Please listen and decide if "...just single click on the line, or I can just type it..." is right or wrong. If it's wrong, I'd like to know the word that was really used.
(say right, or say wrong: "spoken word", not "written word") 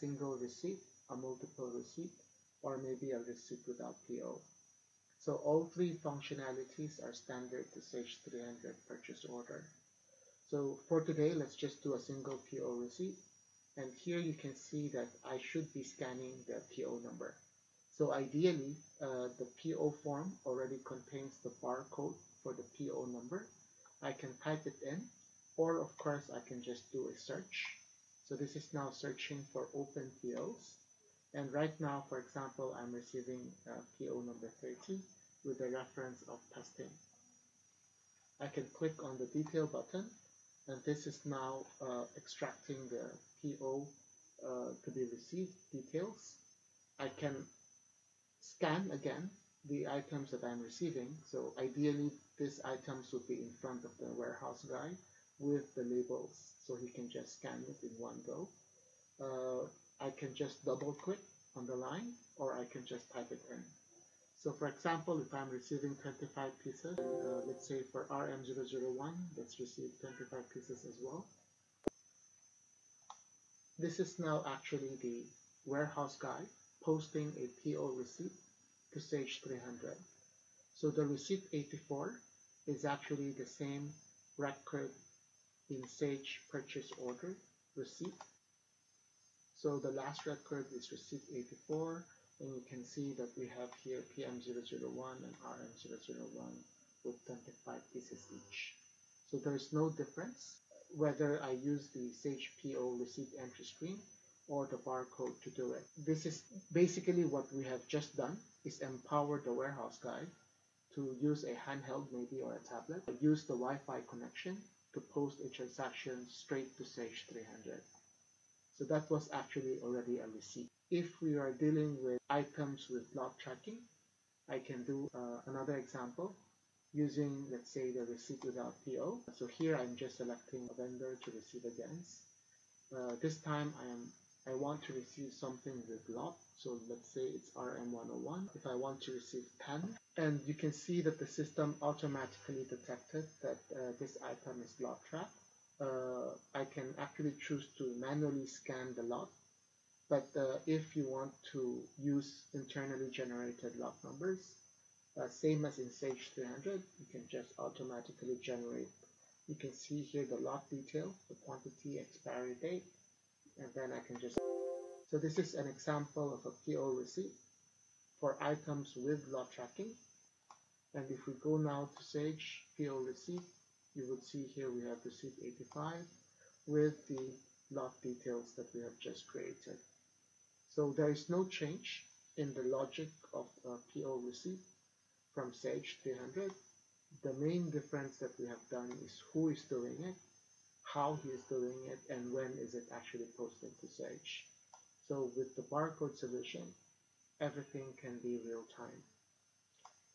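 wrong: "double", not "single".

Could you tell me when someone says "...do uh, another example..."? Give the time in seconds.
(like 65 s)
124 s.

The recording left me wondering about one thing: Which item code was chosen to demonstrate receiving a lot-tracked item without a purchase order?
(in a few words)
RM101.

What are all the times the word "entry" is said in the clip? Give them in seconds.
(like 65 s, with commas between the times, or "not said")
103 s.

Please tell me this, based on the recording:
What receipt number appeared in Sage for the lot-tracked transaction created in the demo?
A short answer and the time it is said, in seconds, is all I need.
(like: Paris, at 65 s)
85, at 175 s.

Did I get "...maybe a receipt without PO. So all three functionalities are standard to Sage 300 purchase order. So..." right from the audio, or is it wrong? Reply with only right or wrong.
right.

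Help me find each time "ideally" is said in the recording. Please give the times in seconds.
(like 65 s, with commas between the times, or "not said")
18 s, 51 s.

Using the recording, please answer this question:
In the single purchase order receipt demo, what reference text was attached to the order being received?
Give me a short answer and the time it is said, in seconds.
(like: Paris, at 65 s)
testing, at 35 s.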